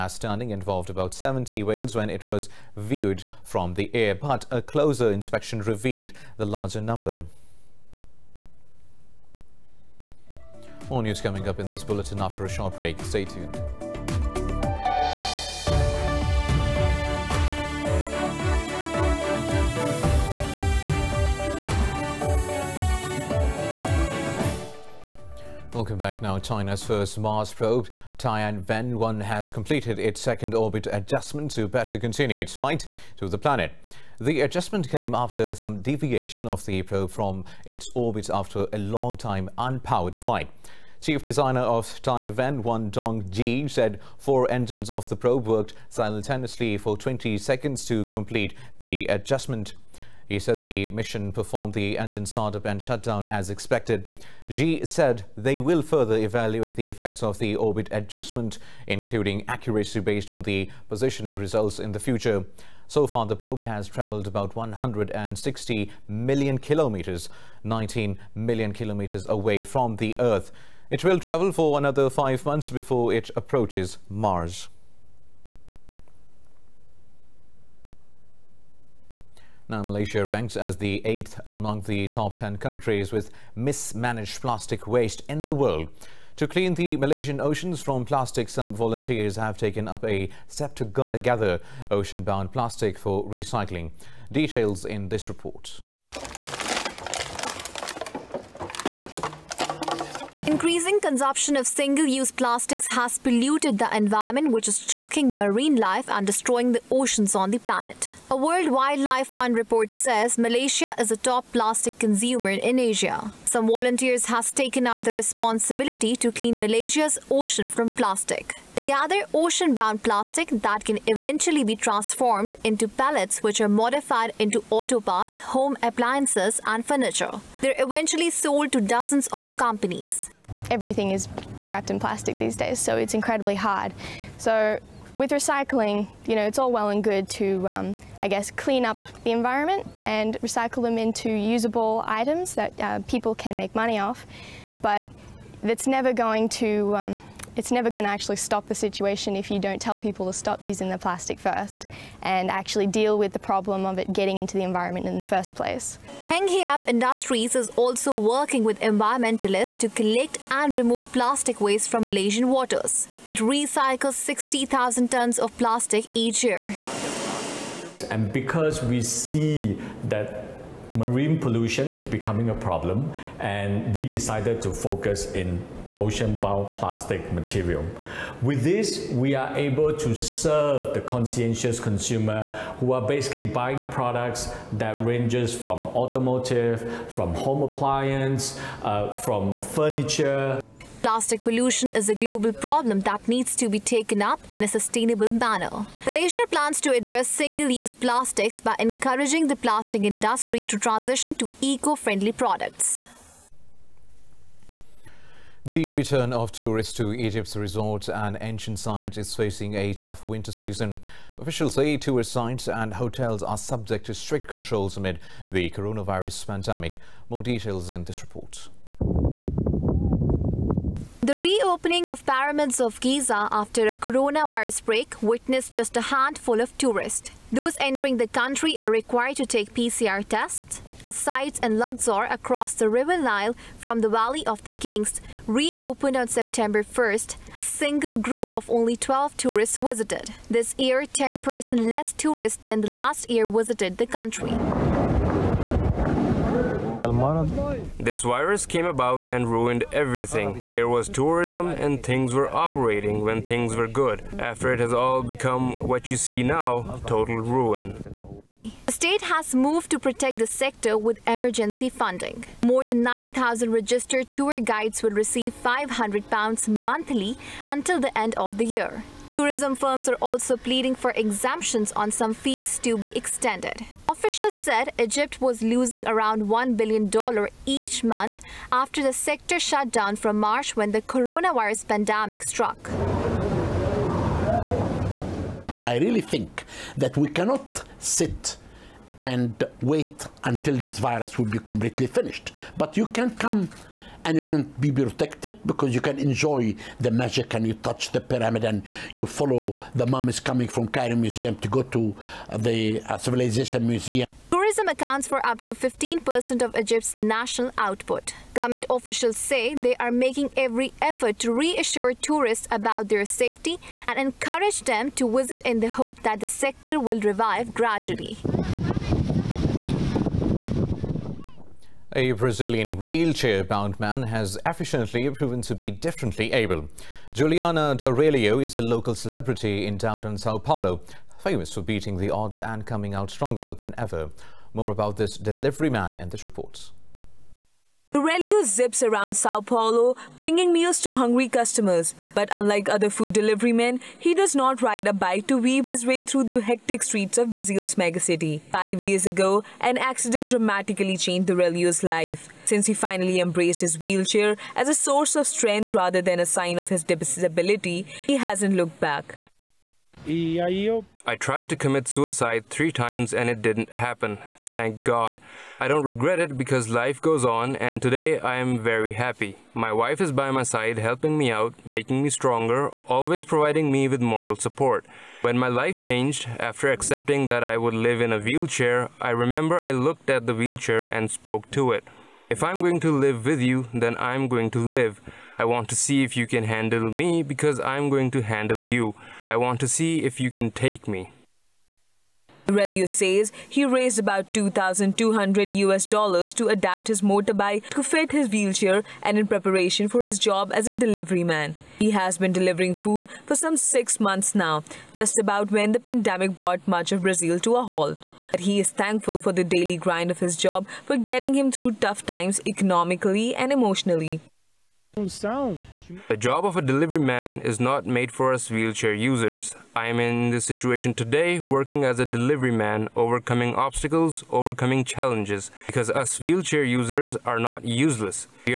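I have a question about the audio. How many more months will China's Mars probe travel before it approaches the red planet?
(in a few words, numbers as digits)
5.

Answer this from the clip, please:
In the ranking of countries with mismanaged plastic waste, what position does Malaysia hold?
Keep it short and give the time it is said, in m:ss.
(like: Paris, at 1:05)
eighth, at 1:21.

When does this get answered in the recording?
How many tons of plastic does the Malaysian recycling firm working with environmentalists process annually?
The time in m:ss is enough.
2:44.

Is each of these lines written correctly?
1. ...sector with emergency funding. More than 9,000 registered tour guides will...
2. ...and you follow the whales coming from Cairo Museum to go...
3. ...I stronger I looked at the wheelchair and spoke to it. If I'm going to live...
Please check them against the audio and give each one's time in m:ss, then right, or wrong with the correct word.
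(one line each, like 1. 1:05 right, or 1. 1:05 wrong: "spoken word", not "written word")
1. 4:20 right
2. 4:58 wrong: "mummies", not "whales"
3. 6:19 wrong: "remember", not "stronger".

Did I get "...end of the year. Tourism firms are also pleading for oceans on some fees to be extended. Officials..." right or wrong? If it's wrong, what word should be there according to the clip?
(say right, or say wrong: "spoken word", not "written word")
wrong: "exemptions", not "oceans".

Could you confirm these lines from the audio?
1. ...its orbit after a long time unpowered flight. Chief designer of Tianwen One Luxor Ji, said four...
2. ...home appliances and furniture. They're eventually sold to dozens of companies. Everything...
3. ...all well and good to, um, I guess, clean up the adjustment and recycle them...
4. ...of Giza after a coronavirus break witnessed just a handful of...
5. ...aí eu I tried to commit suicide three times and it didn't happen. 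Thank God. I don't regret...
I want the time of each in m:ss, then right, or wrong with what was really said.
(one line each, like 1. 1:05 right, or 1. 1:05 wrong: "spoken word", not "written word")
1. 0:37 wrong: "Dong", not "Luxor"
2. 2:05 right
3. 2:16 wrong: "environment", not "adjustment"
4. 3:42 right
5. 6:00 right.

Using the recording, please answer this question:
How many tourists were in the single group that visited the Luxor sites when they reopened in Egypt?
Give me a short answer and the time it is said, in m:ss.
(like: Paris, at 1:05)
12, at 3:58.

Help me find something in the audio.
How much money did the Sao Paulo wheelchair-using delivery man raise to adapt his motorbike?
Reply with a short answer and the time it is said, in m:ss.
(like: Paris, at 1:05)
2,200 US dollars, at 6:34.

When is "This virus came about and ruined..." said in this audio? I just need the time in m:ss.
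4:07.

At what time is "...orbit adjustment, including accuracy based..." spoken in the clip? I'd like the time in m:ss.
0:57.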